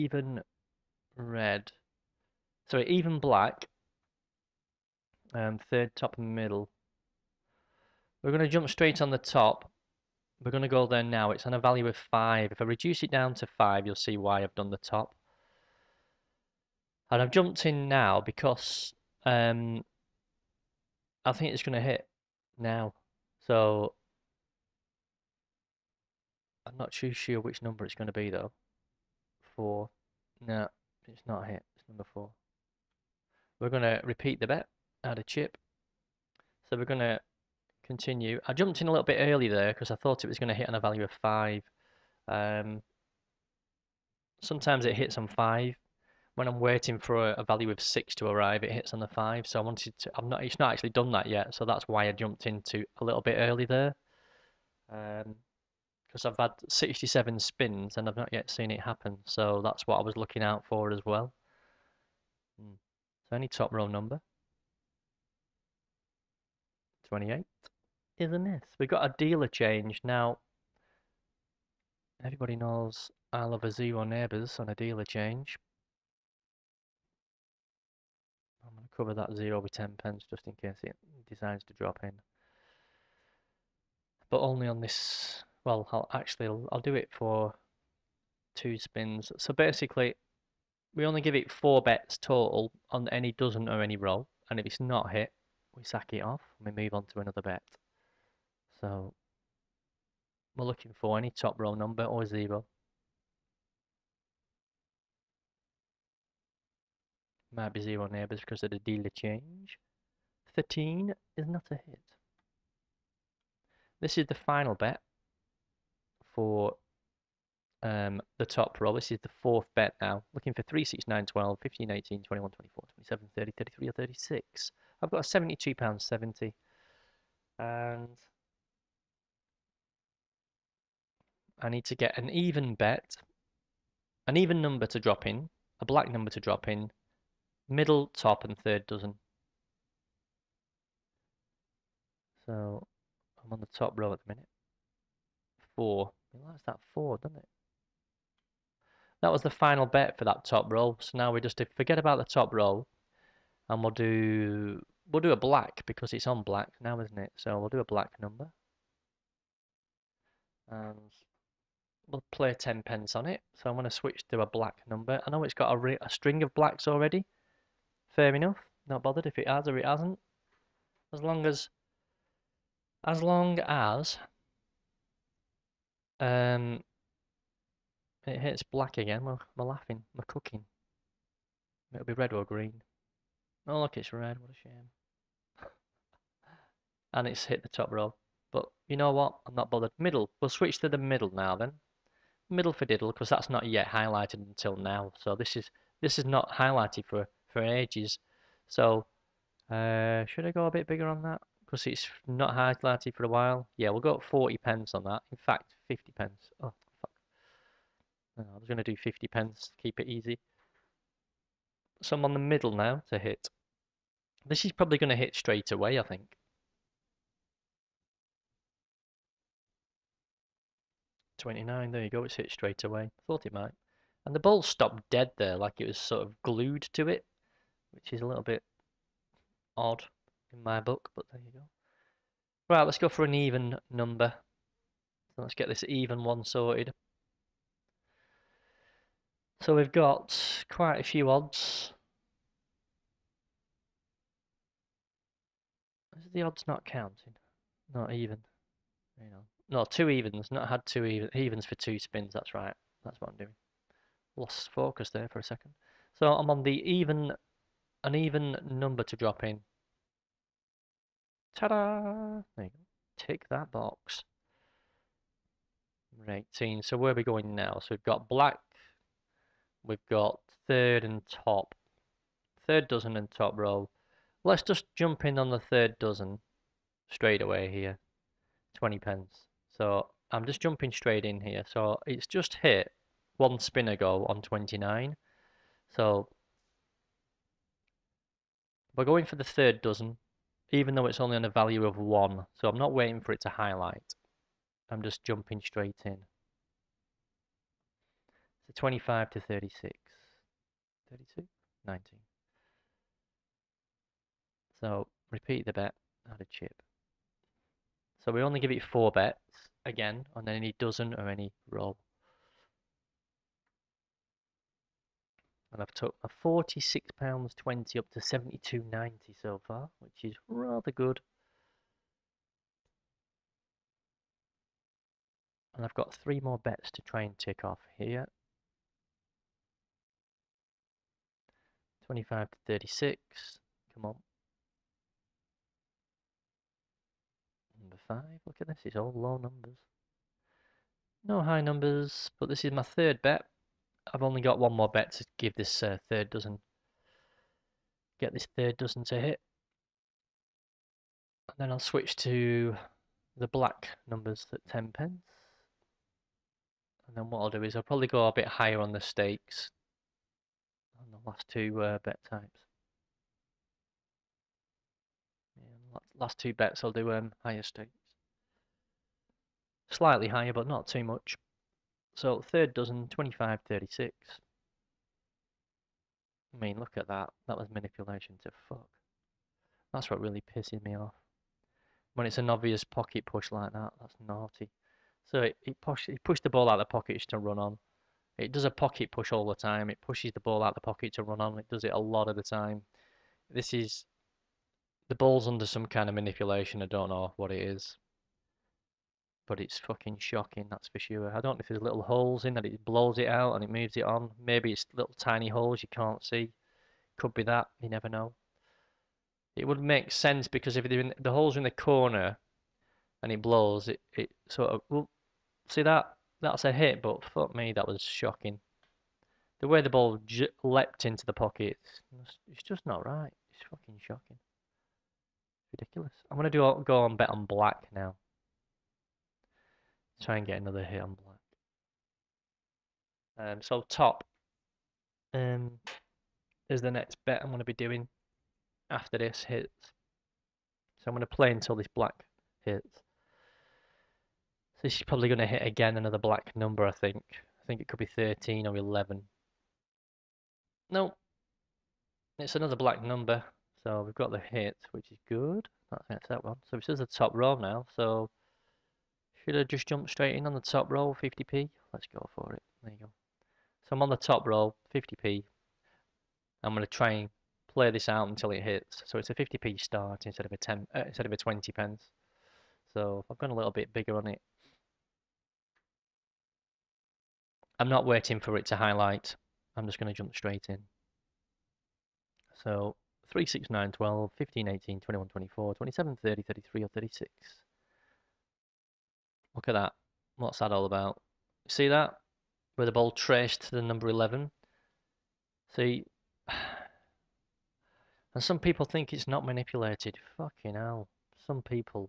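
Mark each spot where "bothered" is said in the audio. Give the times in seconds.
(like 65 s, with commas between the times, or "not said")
169 s, 189 s.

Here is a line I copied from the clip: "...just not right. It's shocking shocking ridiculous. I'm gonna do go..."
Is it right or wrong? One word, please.
wrong.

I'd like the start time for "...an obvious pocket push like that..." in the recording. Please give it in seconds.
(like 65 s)
382 s.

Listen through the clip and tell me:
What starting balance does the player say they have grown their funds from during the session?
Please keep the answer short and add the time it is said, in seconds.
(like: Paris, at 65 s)
£46.20, at 316 s.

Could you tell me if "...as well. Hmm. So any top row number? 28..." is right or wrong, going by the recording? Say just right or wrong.
right.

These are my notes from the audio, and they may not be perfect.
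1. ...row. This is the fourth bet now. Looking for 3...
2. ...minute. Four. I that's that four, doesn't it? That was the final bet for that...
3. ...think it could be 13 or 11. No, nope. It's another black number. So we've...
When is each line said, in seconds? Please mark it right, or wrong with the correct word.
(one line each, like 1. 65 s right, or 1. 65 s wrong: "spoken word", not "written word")
1. 118 s right
2. 144 s right
3. 447 s right.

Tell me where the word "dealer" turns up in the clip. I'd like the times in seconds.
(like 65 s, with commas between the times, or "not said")
69 s, 74 s, 108 s.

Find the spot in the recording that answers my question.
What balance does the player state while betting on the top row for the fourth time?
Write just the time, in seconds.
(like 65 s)
125 s.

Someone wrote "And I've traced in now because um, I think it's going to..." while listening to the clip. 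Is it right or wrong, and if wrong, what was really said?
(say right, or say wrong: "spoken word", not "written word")
wrong: "jumped", not "traced".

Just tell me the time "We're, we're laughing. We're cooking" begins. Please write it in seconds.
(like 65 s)
179 s.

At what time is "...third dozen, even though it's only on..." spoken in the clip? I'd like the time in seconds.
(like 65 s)
289 s.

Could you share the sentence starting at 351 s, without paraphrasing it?
And then I'll switch to the black numbers at 10 pence.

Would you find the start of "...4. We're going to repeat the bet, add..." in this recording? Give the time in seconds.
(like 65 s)
32 s.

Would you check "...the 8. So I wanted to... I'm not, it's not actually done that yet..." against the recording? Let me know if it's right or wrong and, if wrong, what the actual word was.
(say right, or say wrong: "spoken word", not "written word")
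wrong: "5", not "8".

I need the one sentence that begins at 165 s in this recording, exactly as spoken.
I know it's got a, a string of blacks already.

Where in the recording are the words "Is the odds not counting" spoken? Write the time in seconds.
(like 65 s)
246 s.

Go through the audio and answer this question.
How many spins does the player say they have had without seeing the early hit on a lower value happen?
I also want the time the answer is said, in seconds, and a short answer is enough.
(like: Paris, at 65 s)
67, at 56 s.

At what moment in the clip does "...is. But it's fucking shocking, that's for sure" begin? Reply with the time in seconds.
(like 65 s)
397 s.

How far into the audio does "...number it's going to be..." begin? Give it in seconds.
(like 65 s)
27 s.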